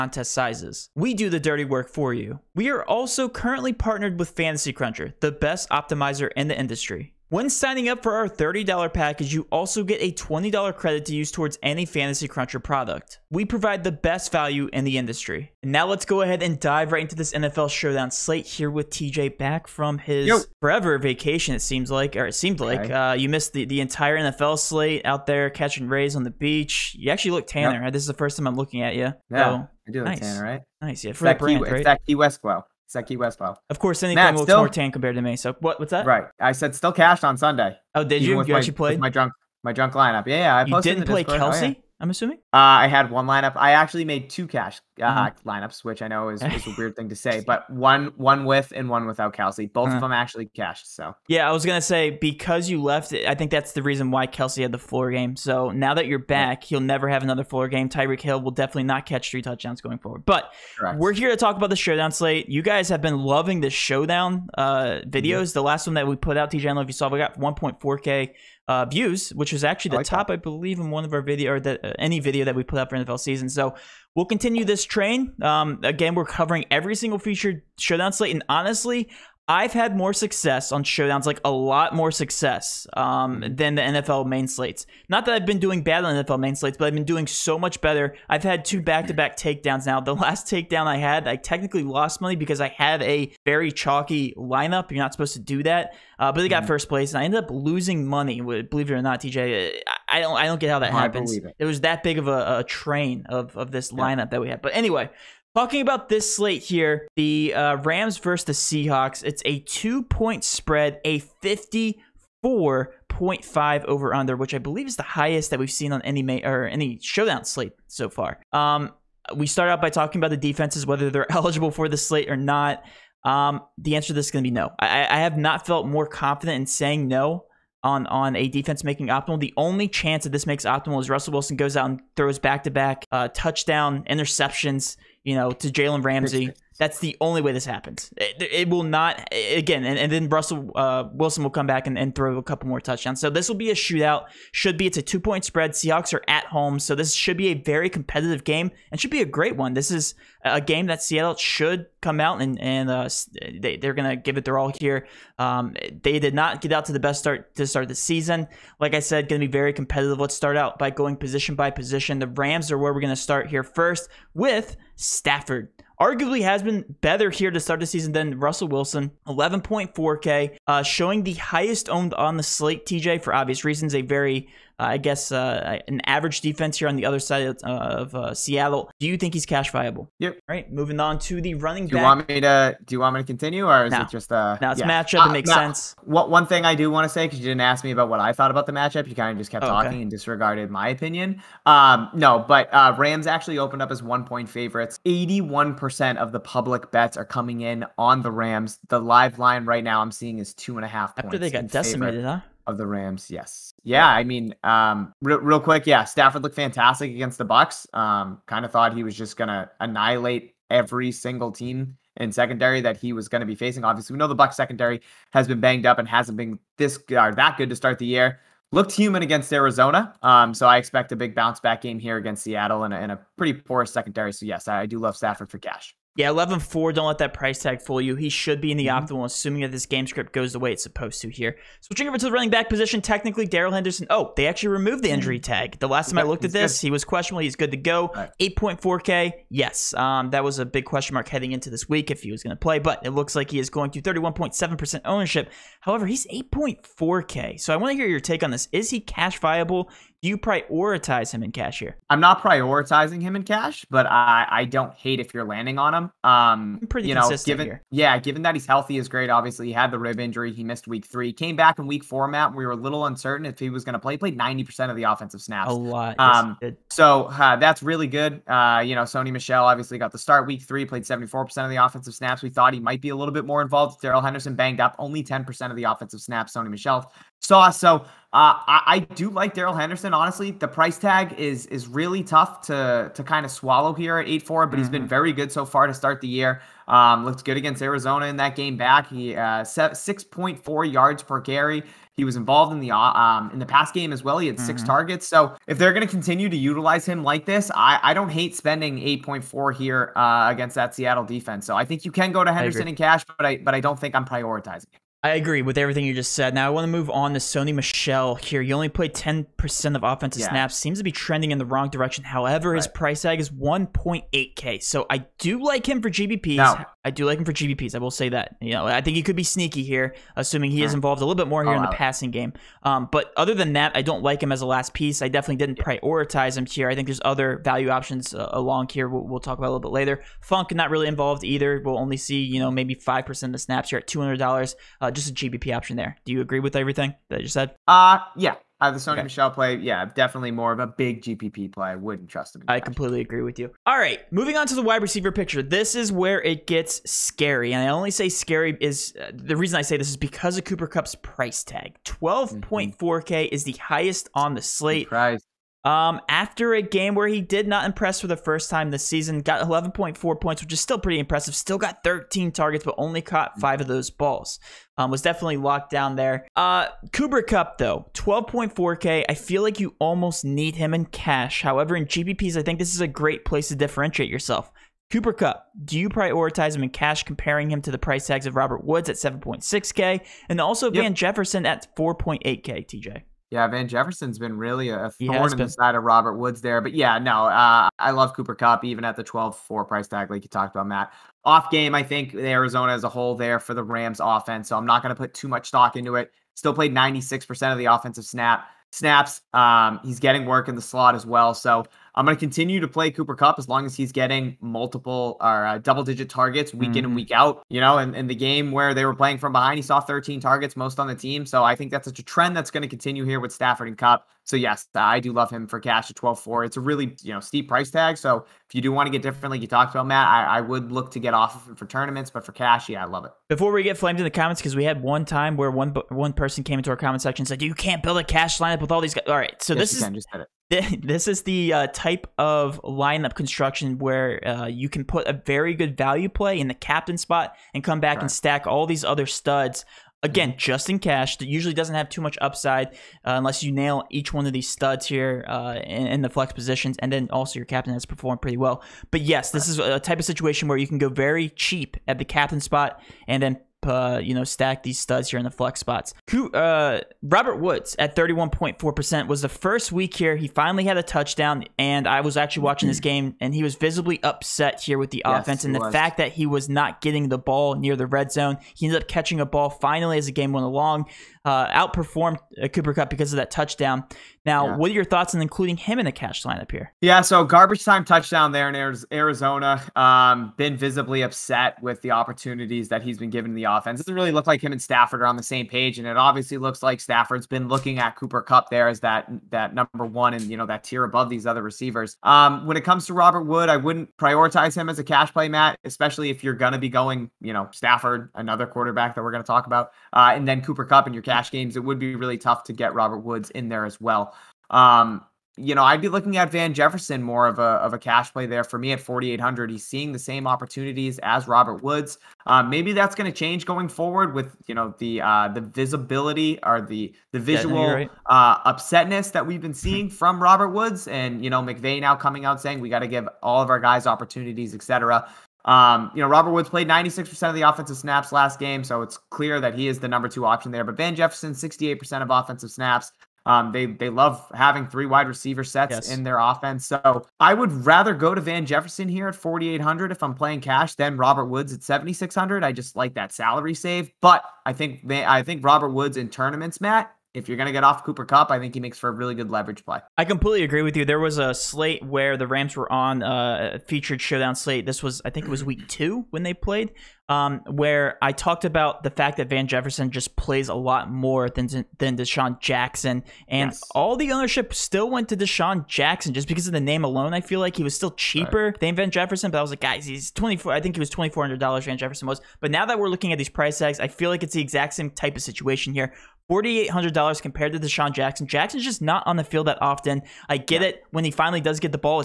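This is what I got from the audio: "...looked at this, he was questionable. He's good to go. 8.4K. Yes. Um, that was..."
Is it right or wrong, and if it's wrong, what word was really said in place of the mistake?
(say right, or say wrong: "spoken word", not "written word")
right.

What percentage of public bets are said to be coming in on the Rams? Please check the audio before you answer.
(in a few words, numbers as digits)
81%.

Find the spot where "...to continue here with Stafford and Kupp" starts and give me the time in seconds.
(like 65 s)
412 s.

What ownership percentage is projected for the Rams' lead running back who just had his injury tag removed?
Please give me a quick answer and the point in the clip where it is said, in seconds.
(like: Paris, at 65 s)
31.7%, at 244 s.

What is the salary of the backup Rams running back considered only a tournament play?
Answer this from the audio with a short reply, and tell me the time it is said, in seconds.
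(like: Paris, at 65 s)
1.8K, at 313 s.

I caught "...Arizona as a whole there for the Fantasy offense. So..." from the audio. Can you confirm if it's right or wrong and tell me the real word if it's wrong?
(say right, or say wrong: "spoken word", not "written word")
wrong: "Rams", not "Fantasy".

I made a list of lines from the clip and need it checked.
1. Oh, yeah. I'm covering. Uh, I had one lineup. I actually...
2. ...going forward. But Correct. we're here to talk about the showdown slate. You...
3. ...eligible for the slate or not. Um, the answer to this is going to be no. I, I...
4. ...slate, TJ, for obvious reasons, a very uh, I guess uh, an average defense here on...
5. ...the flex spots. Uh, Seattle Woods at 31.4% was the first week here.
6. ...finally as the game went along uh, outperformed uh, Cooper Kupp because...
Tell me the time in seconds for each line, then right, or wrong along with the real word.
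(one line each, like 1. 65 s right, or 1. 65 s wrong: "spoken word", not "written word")
1. 41 s wrong: "assuming", not "covering"
2. 59 s right
3. 121 s right
4. 172 s right
5. 455 s wrong: "Robert", not "Seattle"
6. 469 s right.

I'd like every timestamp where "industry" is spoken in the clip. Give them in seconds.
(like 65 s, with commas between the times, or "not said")
6 s, 14 s.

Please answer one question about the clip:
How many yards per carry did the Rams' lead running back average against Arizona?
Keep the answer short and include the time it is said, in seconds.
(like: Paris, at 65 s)
6.4, at 289 s.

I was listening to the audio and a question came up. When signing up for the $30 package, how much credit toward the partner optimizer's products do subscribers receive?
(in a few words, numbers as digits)
$20.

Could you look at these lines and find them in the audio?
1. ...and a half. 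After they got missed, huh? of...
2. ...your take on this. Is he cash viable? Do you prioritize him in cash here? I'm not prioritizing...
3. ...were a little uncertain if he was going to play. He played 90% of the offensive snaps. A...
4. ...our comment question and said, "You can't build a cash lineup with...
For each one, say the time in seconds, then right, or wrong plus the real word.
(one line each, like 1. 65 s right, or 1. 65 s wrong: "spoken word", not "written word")
1. 200 s wrong: "decimated", not "missed"
2. 248 s right
3. 262 s right
4. 426 s wrong: "section", not "question".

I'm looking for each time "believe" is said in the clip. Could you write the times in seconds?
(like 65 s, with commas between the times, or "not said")
70 s, 98 s, 114 s.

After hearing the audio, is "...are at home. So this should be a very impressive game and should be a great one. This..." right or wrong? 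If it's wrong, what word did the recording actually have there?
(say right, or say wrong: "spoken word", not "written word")
wrong: "competitive", not "impressive".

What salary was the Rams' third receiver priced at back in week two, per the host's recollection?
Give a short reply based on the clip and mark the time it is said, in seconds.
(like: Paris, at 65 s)
$2,400, at 571 s.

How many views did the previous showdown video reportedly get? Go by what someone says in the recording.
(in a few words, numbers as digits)
1.4k.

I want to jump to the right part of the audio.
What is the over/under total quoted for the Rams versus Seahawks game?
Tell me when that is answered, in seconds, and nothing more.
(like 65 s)
111 s.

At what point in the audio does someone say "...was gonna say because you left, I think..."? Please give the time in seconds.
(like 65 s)
51 s.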